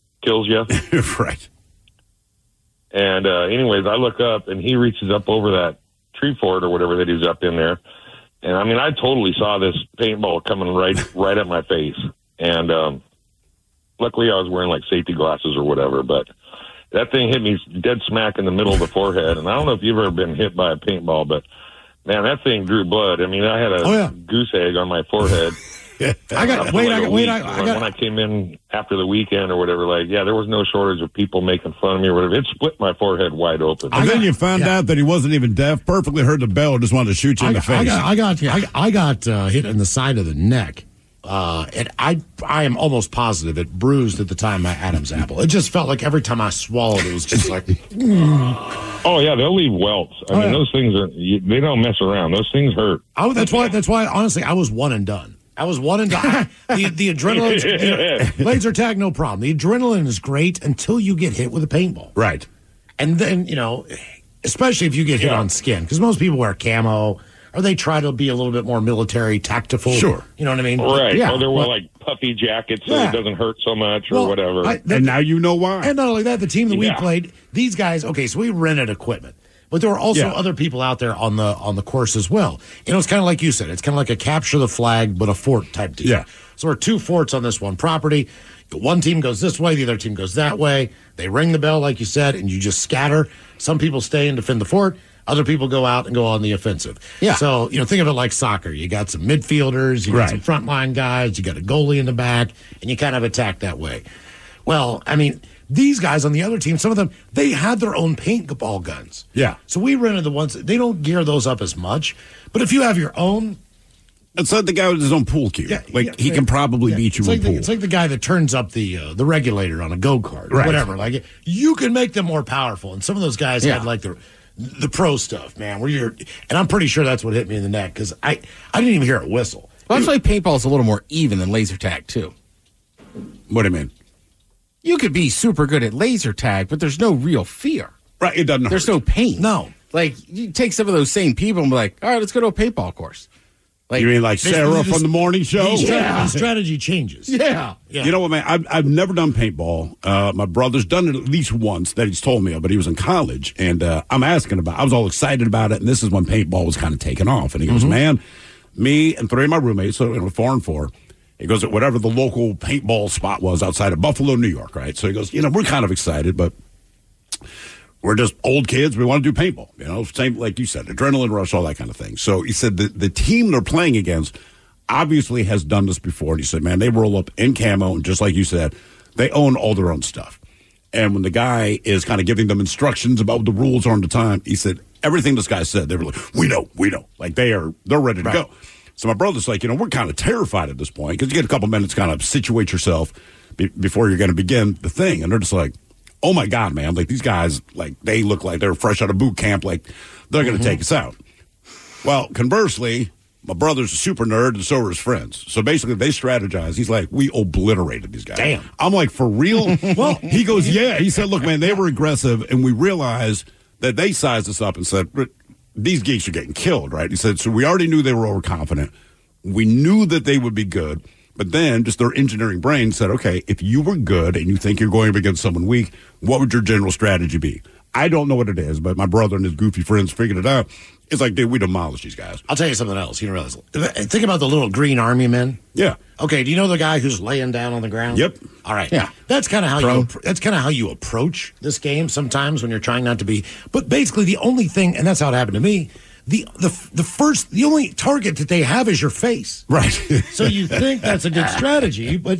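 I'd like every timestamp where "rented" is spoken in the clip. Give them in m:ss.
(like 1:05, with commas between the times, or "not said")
1:18, 1:49.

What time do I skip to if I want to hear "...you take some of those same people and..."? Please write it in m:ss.
2:20.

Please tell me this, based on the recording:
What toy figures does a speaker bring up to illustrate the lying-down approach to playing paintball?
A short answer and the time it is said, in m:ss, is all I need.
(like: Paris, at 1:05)
Little green army men, at 3:54.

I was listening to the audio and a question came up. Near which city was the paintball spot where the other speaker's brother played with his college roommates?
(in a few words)
Buffalo, New York.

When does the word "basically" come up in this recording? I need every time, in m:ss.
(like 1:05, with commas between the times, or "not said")
3:25, 4:03.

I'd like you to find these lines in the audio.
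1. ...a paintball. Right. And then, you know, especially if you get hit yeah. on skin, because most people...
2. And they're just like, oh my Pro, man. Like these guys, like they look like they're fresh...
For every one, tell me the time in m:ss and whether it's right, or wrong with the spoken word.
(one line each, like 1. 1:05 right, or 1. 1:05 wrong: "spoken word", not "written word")
1. 1:01 right
2. 3:15 wrong: "God", not "Pro".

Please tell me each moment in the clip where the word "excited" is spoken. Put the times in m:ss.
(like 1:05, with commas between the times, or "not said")
2:35, 2:45.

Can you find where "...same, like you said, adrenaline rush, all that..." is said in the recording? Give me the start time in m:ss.
2:50.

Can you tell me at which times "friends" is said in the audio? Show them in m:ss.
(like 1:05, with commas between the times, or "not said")
3:24, 3:49.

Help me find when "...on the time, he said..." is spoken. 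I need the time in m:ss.
3:03.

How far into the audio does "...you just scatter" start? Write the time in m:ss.
1:32.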